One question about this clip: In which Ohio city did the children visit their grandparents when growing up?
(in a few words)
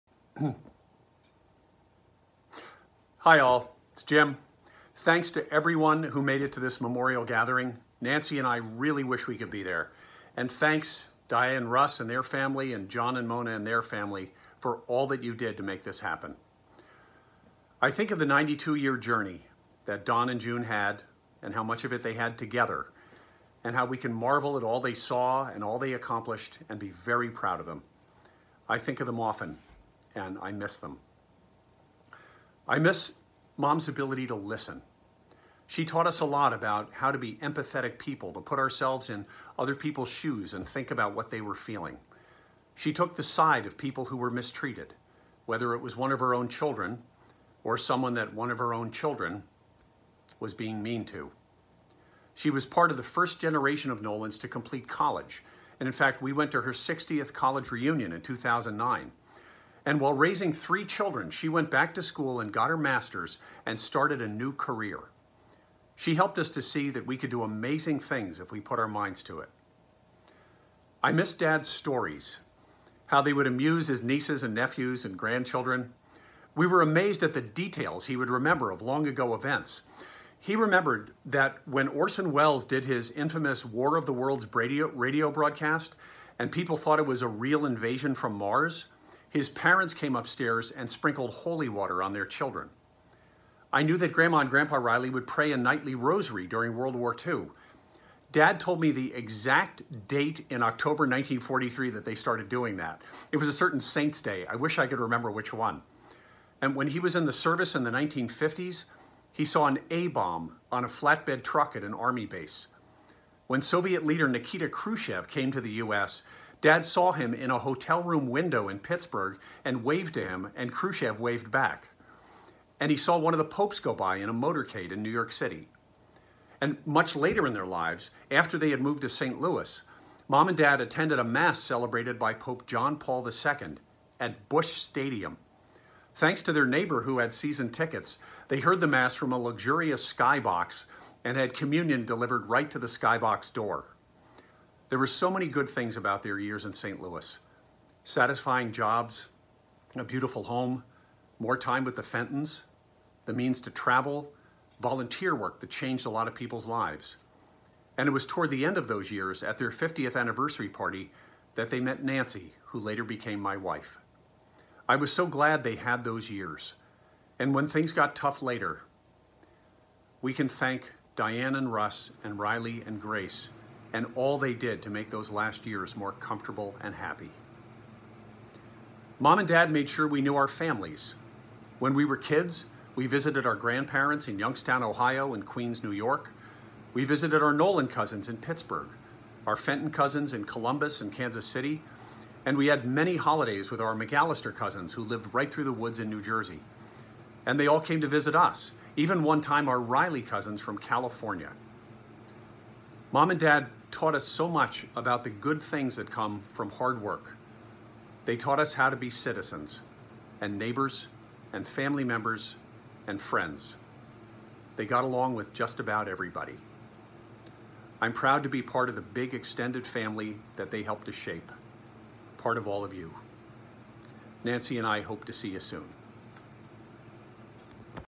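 Youngstown.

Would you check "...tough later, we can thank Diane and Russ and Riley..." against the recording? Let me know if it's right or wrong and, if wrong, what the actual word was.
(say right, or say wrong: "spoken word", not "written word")
right.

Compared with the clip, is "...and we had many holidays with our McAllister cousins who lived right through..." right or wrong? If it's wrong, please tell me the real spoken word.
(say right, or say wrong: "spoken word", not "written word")
right.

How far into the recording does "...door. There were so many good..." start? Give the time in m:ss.
2:23.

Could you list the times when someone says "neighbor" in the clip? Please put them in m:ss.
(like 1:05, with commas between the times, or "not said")
2:16, 3:30.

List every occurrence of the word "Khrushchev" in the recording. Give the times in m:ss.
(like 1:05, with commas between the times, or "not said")
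1:54, 2:00.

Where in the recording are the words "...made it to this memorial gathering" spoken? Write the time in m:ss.
0:06.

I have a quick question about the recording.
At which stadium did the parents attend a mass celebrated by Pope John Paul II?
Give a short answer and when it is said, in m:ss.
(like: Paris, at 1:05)
Busch Stadium, at 2:14.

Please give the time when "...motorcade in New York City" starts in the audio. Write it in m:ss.
2:04.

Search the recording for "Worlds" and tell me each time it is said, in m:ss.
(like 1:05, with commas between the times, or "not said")
1:24, 1:36.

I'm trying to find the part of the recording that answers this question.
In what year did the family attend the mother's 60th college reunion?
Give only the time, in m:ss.
0:58.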